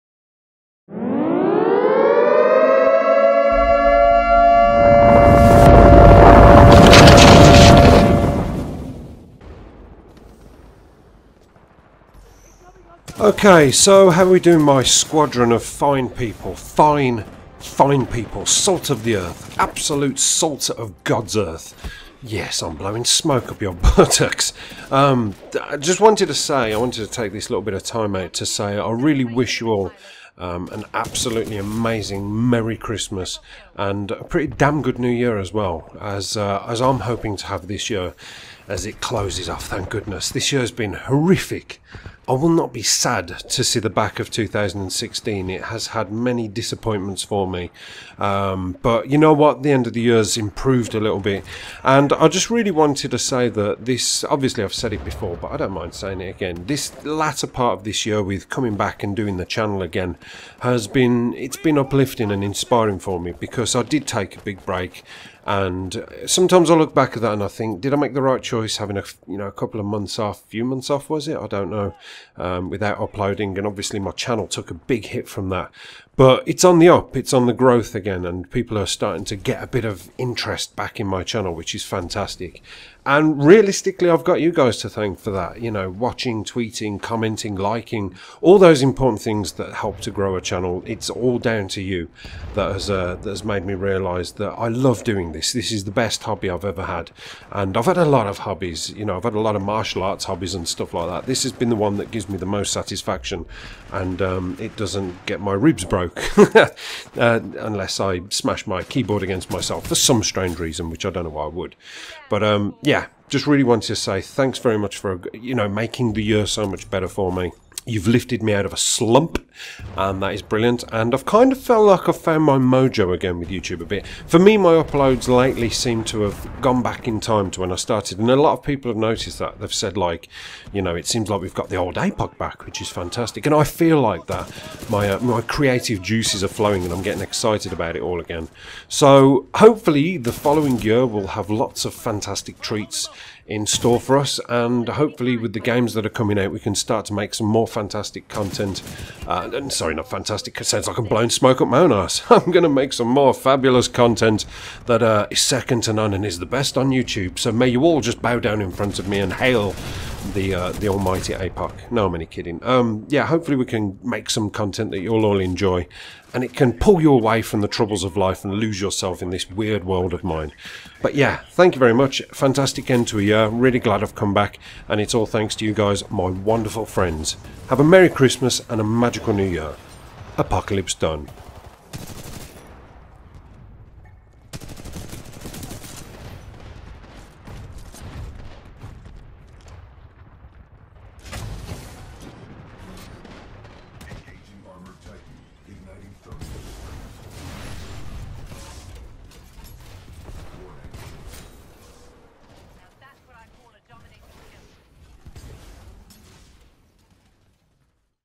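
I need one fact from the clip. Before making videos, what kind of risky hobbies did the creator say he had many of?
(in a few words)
Martial arts.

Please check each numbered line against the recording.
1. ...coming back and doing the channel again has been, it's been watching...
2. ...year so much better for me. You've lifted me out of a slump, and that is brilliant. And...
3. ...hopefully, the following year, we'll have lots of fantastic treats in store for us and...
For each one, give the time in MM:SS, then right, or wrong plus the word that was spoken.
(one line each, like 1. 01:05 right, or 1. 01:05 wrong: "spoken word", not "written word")
1. 00:58 wrong: "uplifting", not "watching"
2. 01:56 right
3. 02:19 right.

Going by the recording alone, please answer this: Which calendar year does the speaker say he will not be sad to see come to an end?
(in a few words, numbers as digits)
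2016.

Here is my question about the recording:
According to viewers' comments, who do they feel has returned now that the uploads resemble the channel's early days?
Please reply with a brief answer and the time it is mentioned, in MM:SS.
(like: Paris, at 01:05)
The old APOC, at 02:11.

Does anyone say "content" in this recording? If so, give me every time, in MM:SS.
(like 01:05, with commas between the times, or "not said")
02:28, 02:33, 02:44.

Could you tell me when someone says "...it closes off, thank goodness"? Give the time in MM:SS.
00:38.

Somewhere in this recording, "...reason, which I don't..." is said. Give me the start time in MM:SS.
01:50.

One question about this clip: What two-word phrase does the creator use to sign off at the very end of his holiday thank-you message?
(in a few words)
Apocalypse done.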